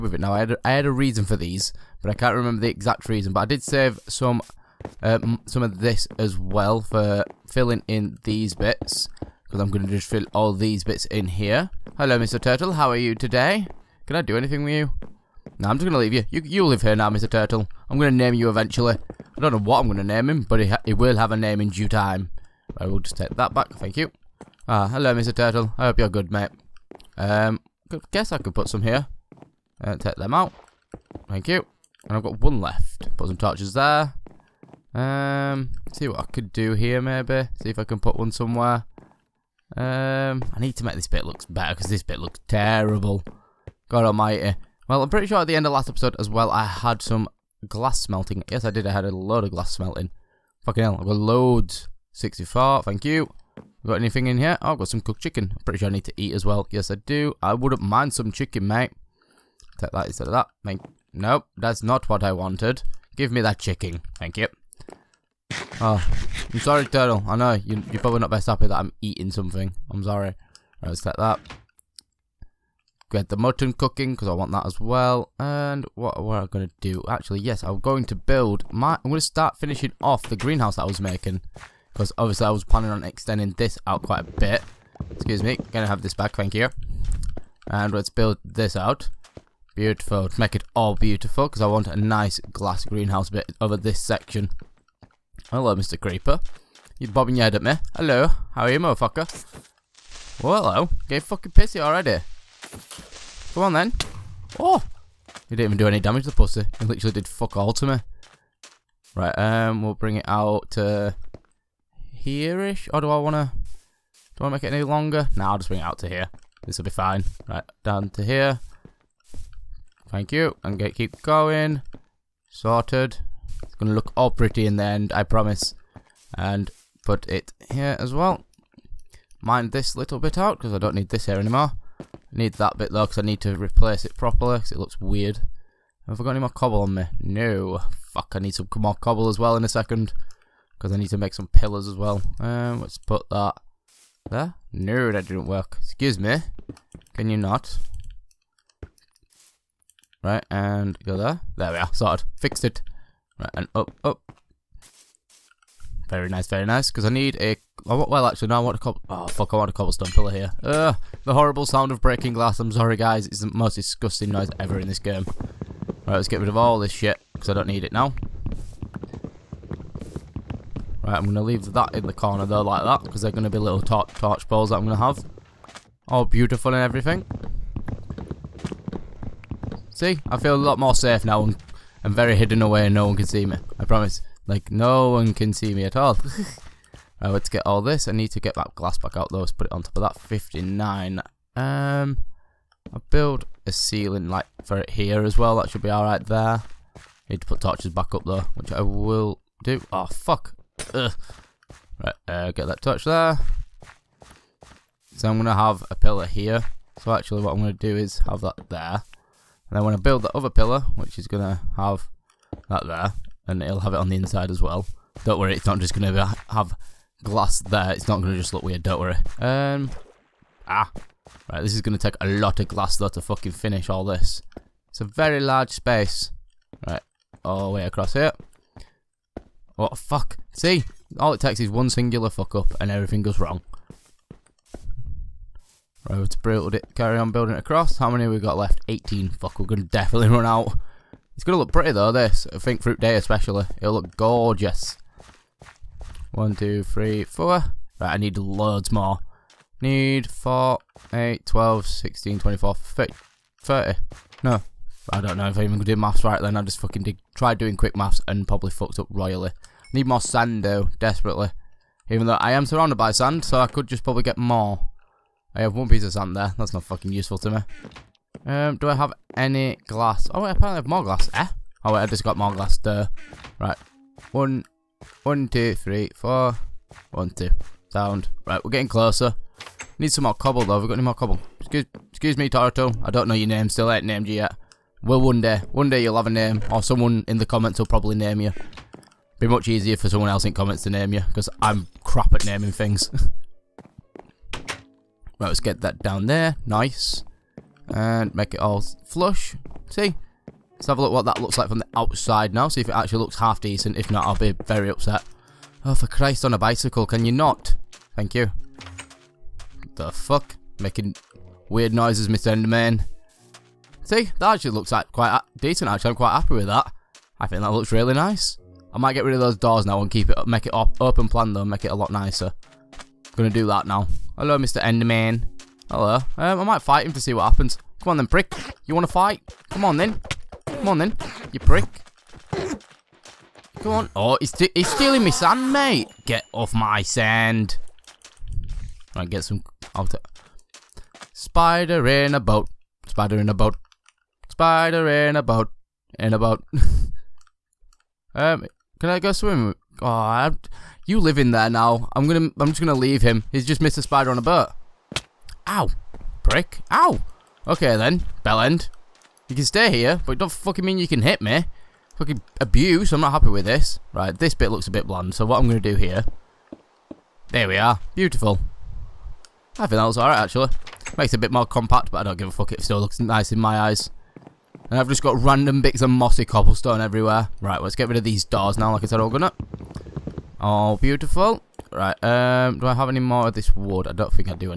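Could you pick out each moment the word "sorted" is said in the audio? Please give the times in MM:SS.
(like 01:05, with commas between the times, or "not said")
02:02, 02:31.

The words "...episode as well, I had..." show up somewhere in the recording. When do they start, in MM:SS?
00:45.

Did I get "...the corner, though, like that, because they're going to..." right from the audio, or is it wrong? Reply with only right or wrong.
right.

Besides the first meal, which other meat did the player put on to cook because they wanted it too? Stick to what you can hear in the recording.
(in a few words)
Mutton.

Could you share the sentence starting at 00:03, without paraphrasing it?
But I did save some um, some of this as well for filling in these bits.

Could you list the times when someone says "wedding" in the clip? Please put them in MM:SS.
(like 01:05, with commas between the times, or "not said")
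not said.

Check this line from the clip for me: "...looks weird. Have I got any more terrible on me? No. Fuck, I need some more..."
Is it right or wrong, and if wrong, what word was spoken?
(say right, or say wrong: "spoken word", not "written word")
wrong: "cobble", not "terrible".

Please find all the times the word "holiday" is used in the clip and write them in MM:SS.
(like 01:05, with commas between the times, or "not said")
not said.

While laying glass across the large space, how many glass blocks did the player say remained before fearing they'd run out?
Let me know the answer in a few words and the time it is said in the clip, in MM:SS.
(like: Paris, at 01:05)
18, at 03:58.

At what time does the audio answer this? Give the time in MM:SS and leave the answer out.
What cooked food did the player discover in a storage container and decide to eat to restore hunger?
00:54.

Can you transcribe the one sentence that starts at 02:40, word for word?
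Ugh, the horrible sound of breaking glass.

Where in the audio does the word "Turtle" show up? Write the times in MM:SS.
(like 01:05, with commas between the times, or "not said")
00:12, 00:17, 00:25, 01:06.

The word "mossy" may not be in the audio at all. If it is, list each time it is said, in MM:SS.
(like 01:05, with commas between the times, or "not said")
06:16.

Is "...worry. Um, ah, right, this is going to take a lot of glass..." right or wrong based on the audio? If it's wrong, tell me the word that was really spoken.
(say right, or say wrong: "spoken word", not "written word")
right.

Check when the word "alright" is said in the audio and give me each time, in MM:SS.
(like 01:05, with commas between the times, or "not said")
03:15, 06:10.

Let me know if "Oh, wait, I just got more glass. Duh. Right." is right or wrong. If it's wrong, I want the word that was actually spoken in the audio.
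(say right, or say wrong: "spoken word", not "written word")
right.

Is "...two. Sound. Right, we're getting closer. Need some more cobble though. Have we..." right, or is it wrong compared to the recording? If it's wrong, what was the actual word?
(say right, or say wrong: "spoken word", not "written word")
right.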